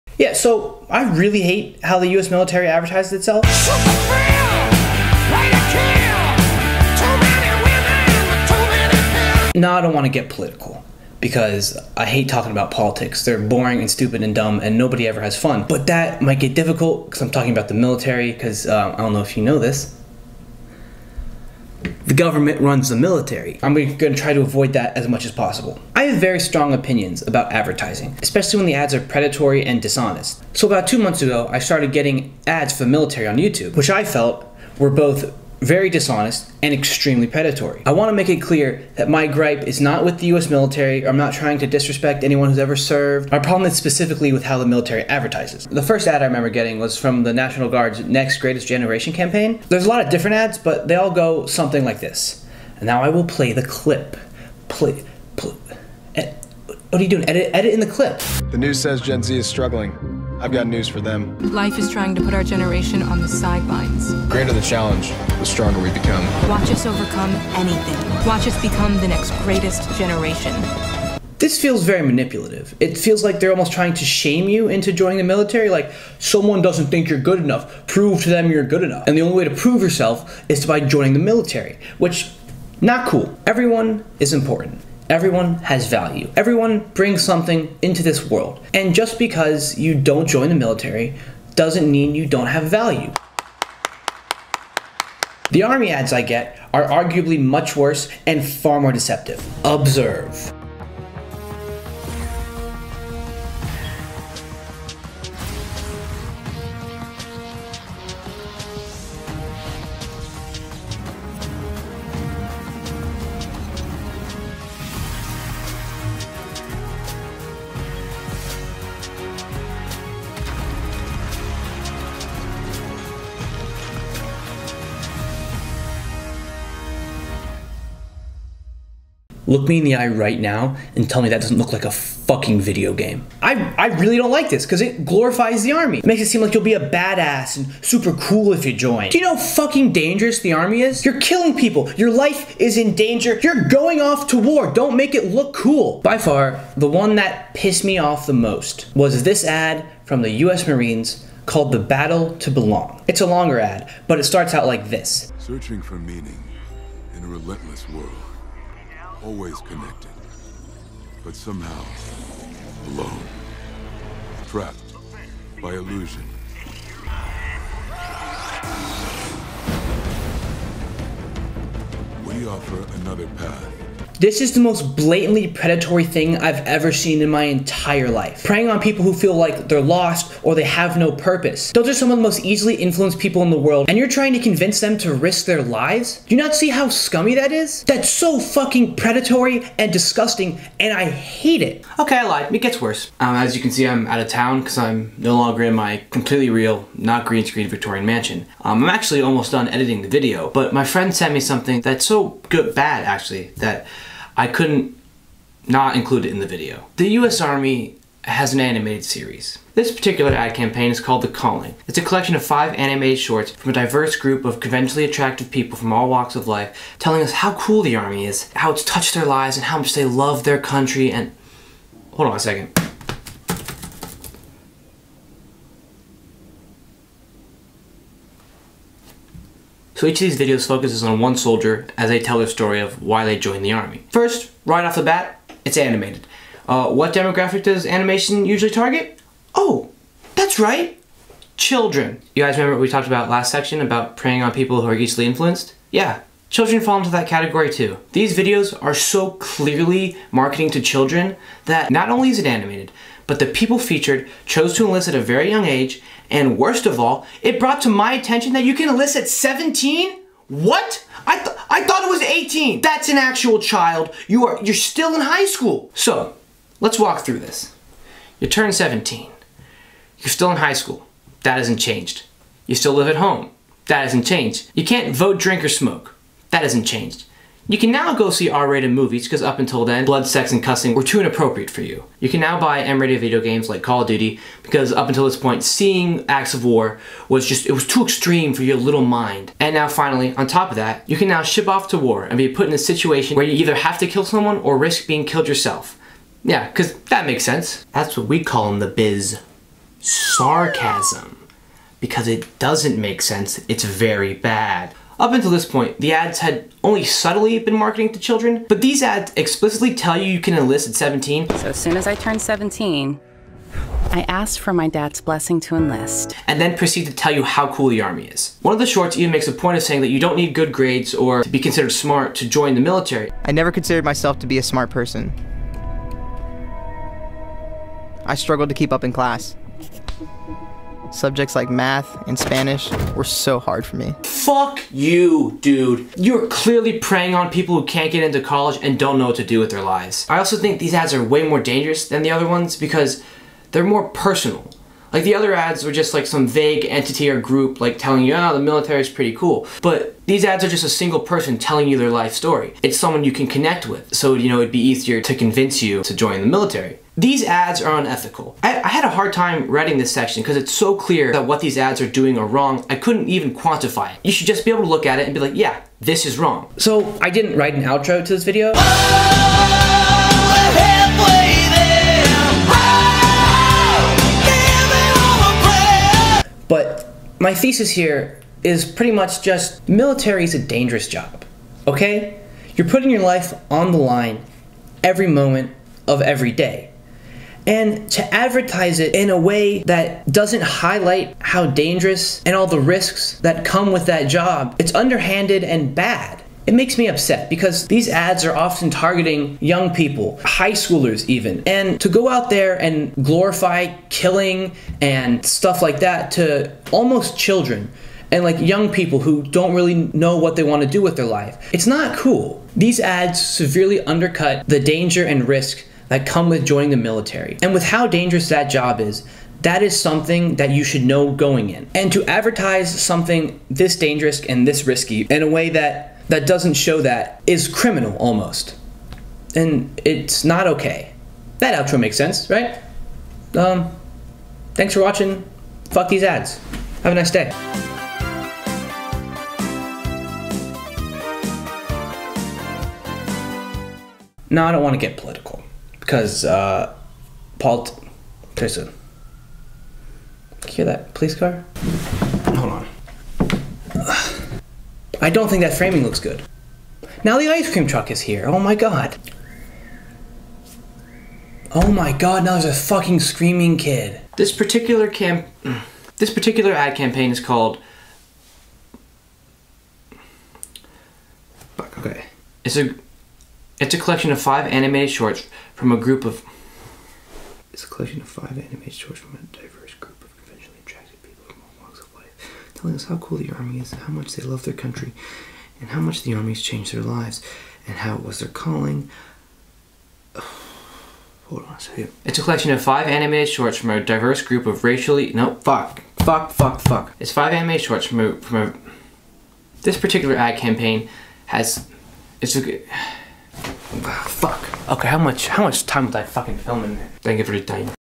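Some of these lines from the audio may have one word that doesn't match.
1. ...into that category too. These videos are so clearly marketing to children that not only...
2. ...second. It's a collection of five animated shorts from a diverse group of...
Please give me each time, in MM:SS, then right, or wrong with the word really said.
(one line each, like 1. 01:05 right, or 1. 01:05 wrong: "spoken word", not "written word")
1. 04:06 right
2. 08:11 right.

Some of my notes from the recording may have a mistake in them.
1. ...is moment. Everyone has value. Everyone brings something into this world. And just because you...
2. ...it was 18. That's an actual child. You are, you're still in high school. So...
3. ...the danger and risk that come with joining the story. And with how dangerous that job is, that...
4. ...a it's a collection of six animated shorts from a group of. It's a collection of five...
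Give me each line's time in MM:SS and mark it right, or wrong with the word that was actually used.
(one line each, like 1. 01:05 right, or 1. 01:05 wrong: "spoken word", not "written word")
1. 01:24 wrong: "important", not "moment"
2. 04:22 right
3. 06:54 wrong: "military", not "story"
4. 07:52 wrong: "five", not "six".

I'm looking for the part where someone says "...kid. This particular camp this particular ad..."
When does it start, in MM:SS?
07:43.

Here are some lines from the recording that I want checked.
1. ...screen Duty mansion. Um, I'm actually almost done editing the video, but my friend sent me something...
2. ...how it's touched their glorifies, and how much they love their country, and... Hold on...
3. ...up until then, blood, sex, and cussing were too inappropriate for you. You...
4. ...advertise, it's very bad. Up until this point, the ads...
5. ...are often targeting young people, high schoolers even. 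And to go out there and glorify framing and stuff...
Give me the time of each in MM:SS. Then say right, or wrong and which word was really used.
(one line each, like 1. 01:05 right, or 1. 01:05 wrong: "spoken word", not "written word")
1. 03:17 wrong: "Victorian", not "Duty"
2. 03:38 wrong: "lives", not "glorifies"
3. 04:39 right
4. 05:03 wrong: "sense", not "advertise"
5. 06:38 wrong: "killing", not "framing".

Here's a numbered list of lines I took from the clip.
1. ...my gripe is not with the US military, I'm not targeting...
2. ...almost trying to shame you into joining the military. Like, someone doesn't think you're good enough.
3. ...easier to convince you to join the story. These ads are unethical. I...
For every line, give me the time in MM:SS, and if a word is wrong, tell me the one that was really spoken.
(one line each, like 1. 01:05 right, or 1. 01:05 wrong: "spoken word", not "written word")
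1. 00:39 wrong: "trying", not "targeting"
2. 01:13 right
3. 05:54 wrong: "military", not "story".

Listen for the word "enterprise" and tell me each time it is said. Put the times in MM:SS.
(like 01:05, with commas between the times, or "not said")
not said.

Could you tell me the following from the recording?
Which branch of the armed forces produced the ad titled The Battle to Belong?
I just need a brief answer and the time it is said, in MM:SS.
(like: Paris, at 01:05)
US Marines, at 02:30.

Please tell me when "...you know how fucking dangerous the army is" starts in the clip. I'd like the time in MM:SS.
02:19.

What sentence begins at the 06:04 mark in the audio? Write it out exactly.
You should just be able to look at it and be like, yeah, this is wrong.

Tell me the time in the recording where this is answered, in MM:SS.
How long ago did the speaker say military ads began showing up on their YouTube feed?
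00:30.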